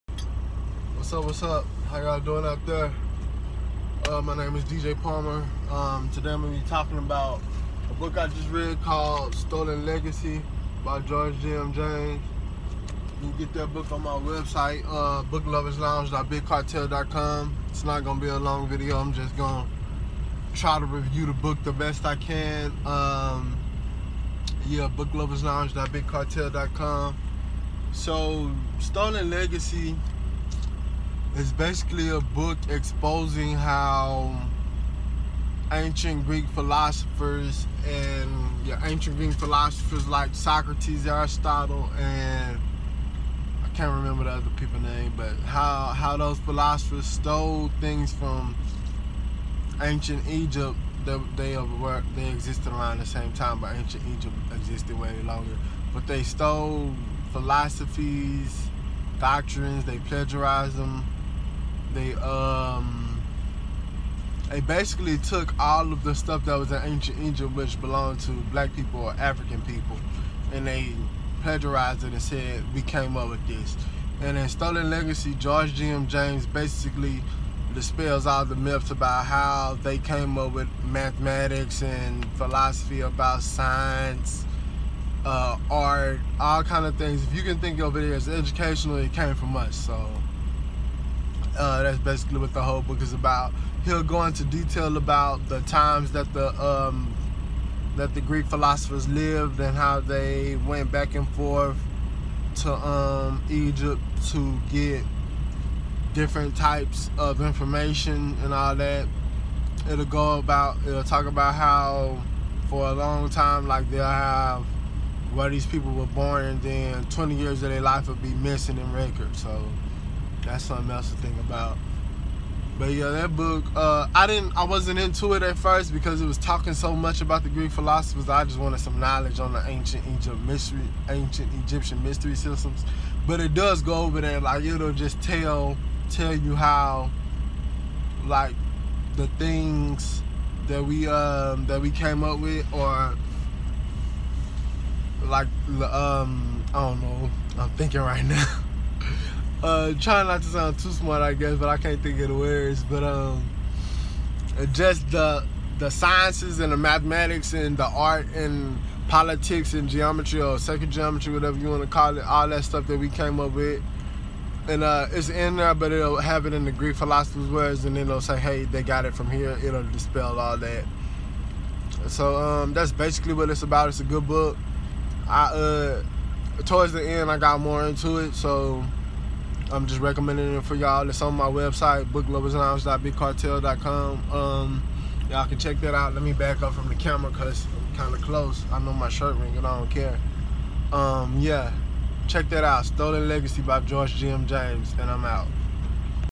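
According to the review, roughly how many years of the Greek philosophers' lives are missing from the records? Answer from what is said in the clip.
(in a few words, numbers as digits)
20.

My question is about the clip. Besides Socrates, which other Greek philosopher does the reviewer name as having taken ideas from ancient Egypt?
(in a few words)
Aristotle.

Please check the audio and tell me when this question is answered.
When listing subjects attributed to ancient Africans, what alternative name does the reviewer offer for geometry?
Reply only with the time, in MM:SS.
02:40.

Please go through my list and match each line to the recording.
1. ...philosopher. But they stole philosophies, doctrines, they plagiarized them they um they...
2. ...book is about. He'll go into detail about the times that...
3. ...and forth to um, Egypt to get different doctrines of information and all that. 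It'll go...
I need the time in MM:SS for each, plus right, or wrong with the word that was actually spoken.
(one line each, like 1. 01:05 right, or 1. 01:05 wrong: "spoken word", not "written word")
1. 00:55 wrong: "longer", not "philosopher"
2. 01:32 right
3. 01:41 wrong: "types", not "doctrines".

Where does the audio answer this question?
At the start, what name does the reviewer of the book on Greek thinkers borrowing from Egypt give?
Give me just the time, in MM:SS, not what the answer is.
00:04.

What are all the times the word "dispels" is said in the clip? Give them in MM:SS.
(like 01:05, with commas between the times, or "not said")
01:17, 02:49.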